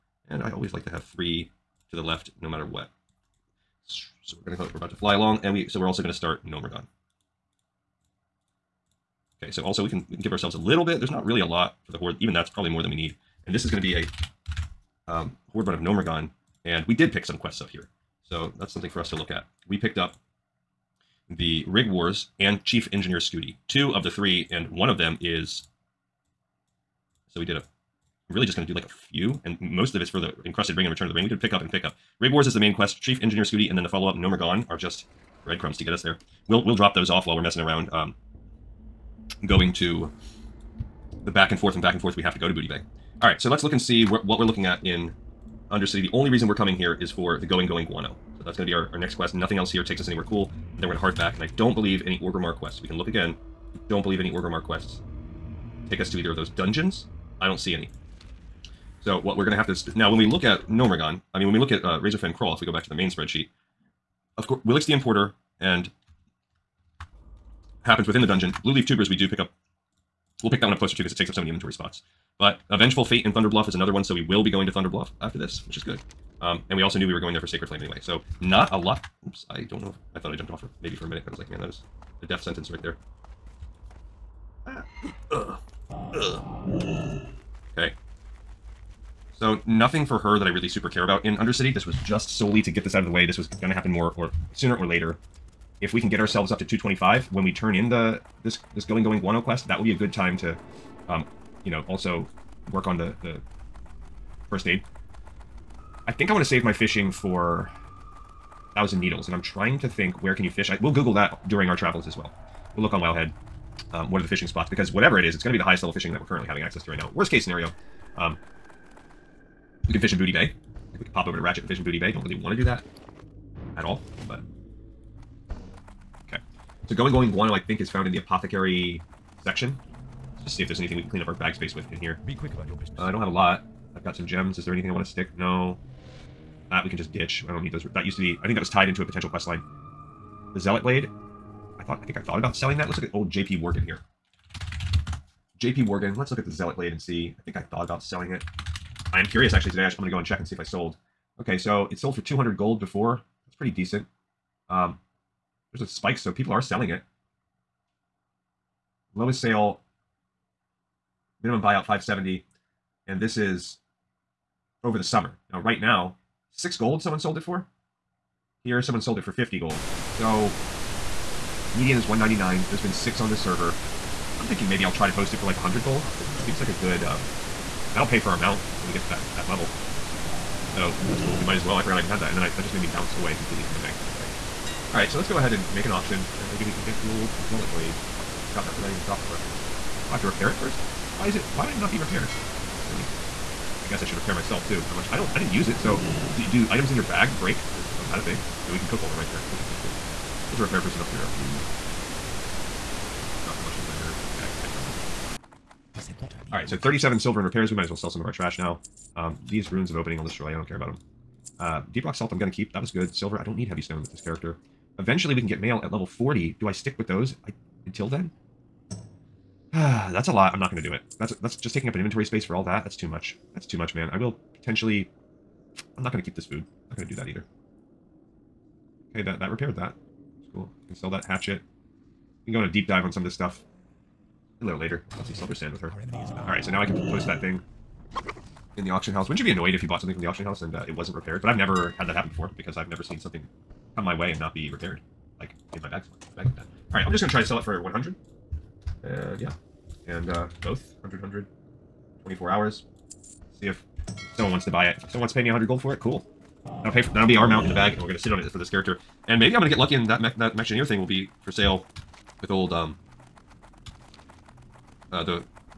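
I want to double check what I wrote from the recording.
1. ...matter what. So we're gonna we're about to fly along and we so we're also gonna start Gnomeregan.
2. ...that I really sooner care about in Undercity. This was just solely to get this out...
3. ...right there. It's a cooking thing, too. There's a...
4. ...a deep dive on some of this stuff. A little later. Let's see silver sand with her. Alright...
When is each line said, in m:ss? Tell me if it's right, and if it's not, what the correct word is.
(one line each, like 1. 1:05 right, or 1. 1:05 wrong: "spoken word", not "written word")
1. 0:02 right
2. 1:30 wrong: "super", not "sooner"
3. 3:19 right
4. 3:52 right.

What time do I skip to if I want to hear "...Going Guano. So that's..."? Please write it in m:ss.
0:47.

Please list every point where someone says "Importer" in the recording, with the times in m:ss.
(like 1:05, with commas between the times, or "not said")
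1:04.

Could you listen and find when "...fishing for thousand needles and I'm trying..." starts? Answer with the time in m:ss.
1:46.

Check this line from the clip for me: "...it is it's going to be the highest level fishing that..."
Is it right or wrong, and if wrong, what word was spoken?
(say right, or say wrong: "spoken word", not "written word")
right.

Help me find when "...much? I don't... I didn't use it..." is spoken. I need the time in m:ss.
3:14.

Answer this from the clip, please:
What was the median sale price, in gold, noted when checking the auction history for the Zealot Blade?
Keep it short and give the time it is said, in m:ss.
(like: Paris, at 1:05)
199, at 2:52.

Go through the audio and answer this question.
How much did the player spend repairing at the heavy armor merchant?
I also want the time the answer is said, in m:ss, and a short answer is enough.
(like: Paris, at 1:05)
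37 silver, at 3:26.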